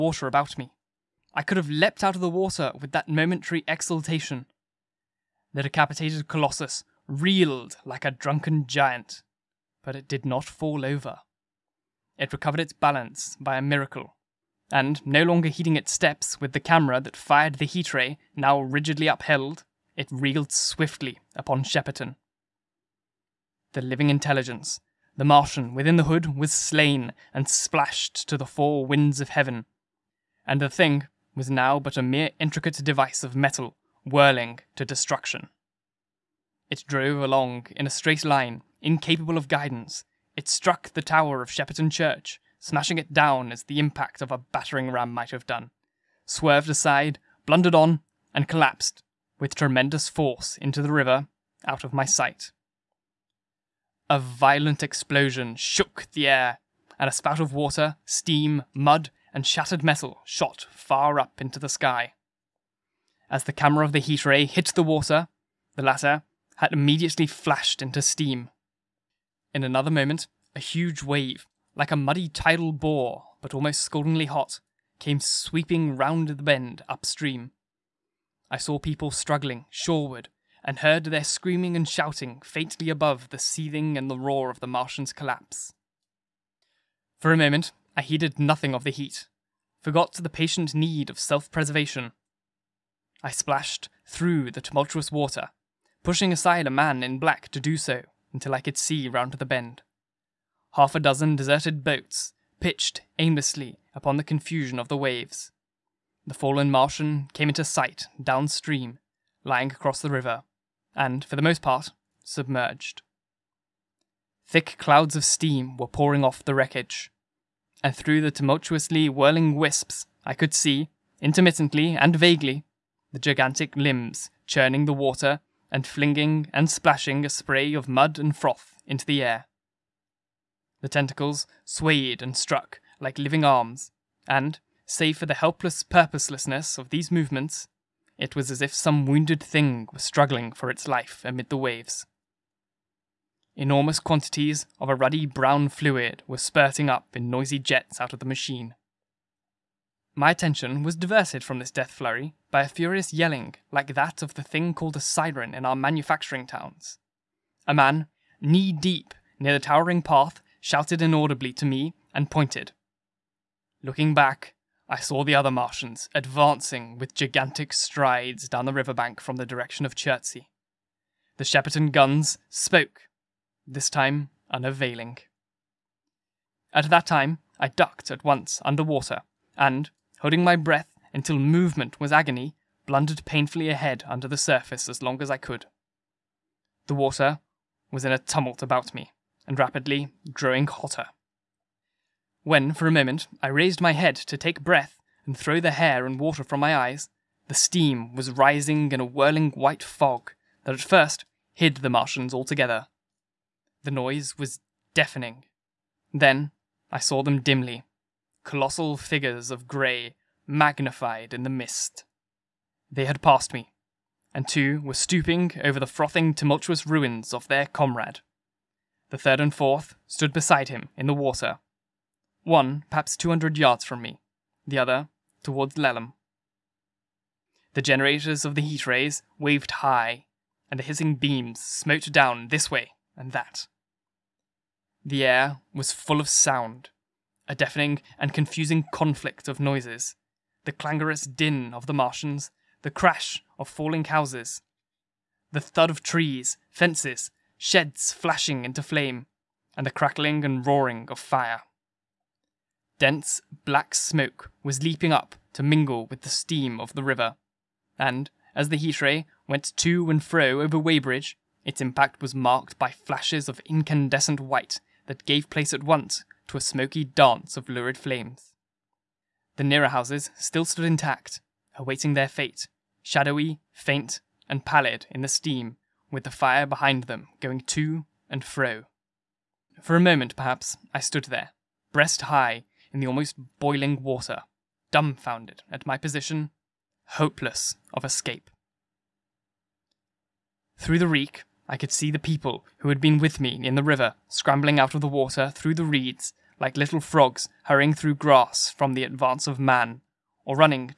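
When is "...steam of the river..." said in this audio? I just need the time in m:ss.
4:16.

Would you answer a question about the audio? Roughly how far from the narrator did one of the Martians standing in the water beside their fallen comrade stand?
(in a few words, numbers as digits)
200 yards.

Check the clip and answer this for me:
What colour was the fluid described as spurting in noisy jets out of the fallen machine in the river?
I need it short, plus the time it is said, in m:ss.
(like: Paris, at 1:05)
ruddy brown, at 2:24.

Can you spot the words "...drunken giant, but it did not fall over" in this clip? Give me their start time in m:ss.
0:08.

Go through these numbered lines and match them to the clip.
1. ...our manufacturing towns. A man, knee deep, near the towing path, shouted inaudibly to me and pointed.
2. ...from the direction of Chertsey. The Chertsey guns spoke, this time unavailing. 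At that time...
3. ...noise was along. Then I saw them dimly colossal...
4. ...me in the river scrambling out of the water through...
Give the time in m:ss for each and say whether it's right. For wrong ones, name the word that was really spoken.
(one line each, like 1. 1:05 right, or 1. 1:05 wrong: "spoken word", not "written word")
1. 2:35 right
2. 2:49 wrong: "Shepperton", not "Chertsey"
3. 3:23 wrong: "deafening", not "along"
4. 4:53 right.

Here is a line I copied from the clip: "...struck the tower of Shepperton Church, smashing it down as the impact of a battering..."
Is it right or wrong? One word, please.
right.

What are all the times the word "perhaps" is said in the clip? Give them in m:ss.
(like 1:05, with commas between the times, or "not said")
3:42, 4:40.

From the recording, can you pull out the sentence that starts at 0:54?
A violent explosion shook the air, and a spout of water, steam, mud, and shattered metal shot far up into the sky.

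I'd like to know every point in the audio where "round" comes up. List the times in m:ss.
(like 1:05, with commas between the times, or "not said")
1:15, 1:39.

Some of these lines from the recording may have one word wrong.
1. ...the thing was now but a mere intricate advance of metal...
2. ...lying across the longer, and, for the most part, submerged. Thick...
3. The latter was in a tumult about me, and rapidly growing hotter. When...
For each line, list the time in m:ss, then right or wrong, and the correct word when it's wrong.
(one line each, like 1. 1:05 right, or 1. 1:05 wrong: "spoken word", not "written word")
1. 0:30 wrong: "device", not "advance"
2. 1:49 wrong: "river", not "longer"
3. 3:06 wrong: "water", not "latter".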